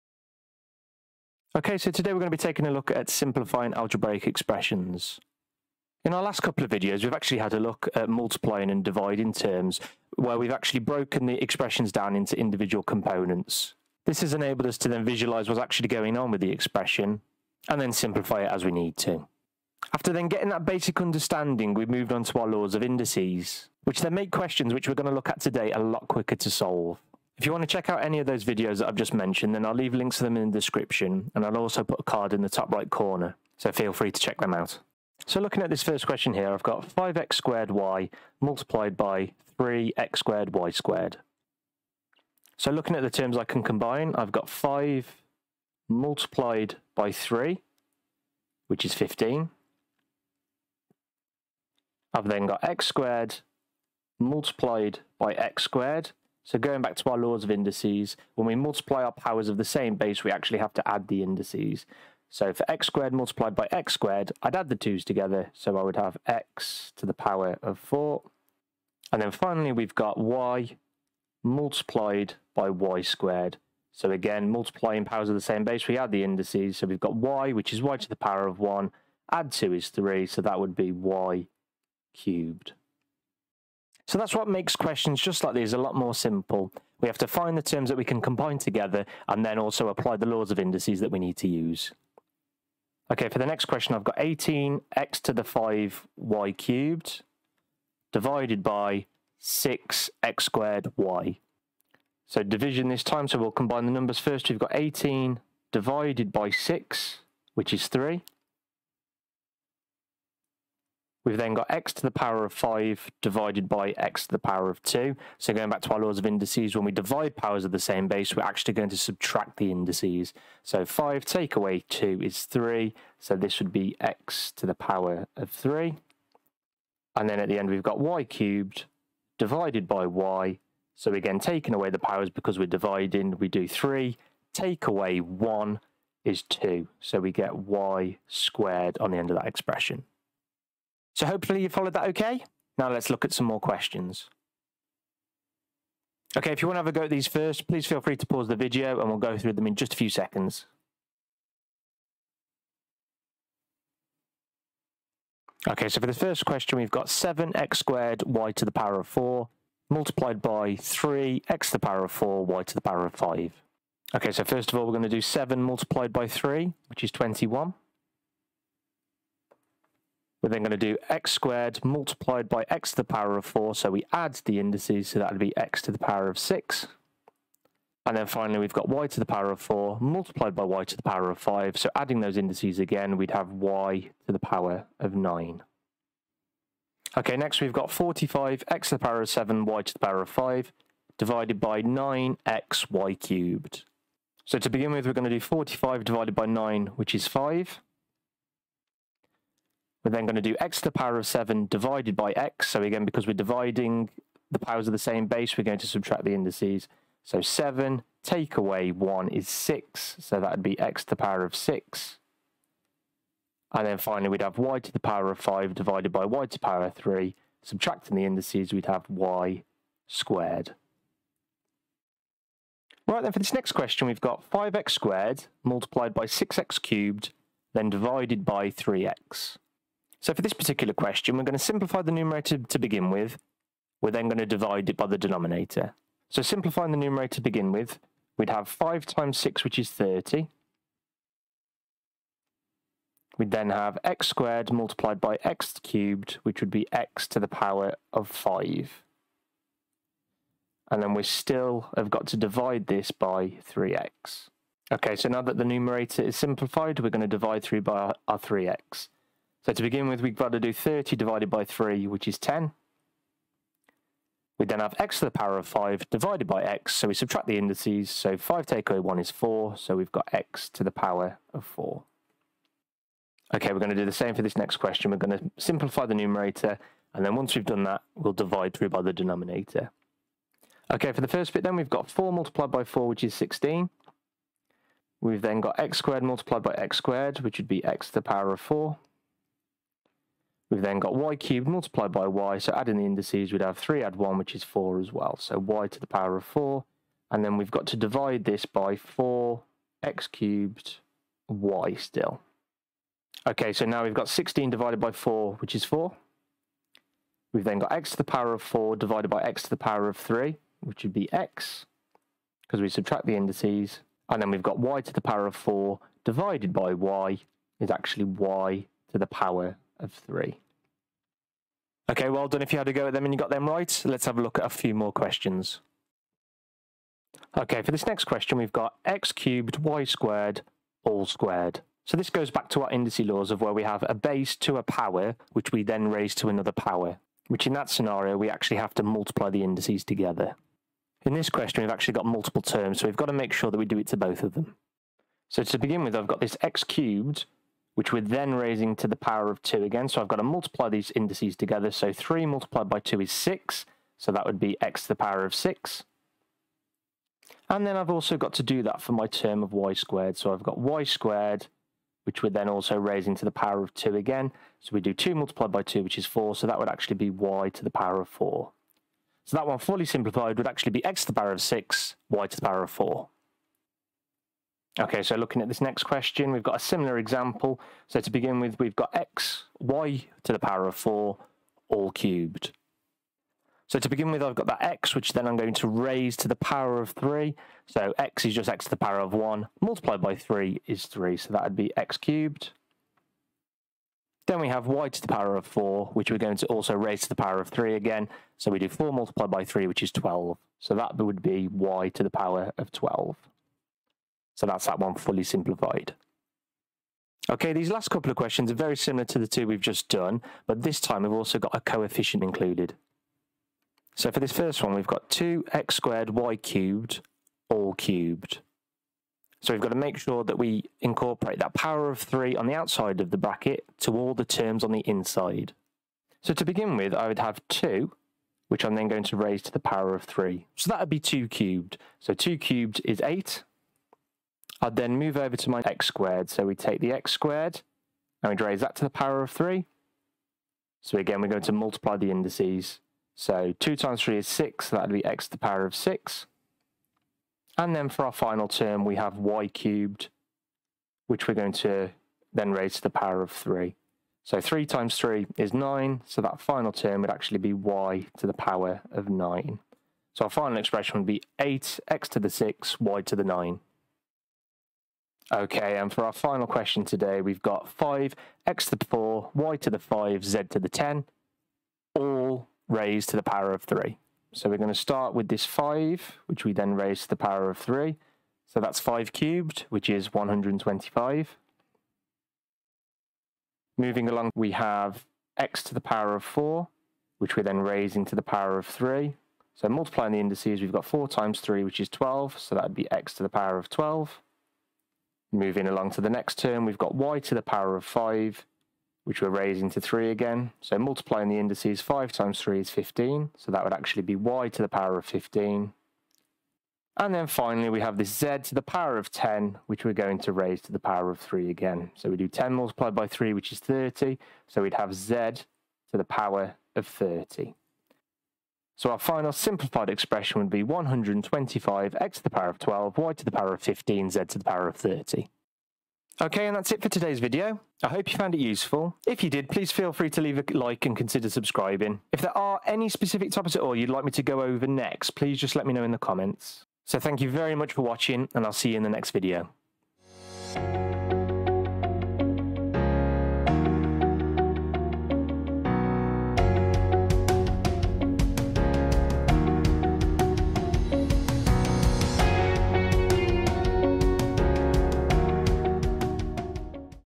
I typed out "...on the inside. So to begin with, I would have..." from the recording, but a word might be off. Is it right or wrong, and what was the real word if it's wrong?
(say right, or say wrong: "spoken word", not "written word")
right.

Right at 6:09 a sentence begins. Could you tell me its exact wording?
So that one fully simplified would actually be x to the power of 6, y to the power of 4.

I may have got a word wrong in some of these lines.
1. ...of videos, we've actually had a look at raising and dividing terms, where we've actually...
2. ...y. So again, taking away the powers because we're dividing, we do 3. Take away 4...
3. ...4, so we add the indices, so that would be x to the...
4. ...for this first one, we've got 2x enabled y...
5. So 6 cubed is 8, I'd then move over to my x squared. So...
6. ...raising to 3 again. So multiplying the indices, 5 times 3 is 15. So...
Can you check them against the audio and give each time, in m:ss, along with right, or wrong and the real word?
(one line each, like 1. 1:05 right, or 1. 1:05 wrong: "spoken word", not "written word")
1. 0:06 wrong: "multiplying", not "raising"
2. 2:10 wrong: "1", not "4"
3. 2:53 right
4. 6:54 wrong: "squared", not "enabled"
5. 7:12 wrong: "2", not "6"
6. 8:19 right.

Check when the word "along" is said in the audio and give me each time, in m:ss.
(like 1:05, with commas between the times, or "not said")
8:04, 8:15.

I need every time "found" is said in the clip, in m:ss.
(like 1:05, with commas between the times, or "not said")
8:48.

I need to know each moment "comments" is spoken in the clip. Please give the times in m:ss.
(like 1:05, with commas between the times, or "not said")
8:56.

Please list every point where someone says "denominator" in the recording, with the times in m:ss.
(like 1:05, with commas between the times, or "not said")
3:55, 4:39.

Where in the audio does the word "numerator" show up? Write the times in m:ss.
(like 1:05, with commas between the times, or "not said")
3:52, 3:56, 4:15, 4:36.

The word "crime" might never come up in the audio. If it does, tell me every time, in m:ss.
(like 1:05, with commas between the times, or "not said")
not said.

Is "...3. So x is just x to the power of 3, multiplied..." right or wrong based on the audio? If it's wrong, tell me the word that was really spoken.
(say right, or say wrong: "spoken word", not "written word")
wrong: "1", not "3".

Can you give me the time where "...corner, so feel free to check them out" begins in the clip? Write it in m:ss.
0:32.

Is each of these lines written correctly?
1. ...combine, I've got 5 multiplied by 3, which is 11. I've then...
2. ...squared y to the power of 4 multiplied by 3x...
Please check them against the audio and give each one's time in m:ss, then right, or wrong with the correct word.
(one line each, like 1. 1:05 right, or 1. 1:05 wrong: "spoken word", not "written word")
1. 0:43 wrong: "15", not "11"
2. 2:37 right.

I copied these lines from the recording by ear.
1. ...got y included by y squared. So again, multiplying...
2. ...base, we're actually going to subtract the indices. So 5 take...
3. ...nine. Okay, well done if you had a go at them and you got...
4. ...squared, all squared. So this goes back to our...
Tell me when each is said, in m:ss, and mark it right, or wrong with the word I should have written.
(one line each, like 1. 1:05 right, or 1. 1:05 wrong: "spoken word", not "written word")
1. 1:09 wrong: "multiplied", not "included"
2. 1:58 right
3. 5:20 wrong: "three", not "nine"
4. 5:30 right.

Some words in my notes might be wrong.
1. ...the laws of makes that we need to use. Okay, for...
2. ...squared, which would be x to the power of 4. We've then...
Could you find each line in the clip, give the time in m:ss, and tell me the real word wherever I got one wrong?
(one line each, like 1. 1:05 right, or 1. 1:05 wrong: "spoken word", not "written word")
1. 1:30 wrong: "indices", not "makes"
2. 4:46 right.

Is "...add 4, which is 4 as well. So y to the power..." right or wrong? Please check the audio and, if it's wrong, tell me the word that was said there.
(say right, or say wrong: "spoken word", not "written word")
wrong: "1", not "4".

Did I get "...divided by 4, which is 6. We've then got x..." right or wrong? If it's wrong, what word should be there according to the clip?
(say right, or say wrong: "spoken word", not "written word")
wrong: "4", not "6".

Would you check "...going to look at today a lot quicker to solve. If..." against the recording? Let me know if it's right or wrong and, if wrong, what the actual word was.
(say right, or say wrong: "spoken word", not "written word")
right.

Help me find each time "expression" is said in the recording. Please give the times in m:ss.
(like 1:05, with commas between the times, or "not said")
0:04, 0:11, 0:16, 2:19, 7:40, 8:40.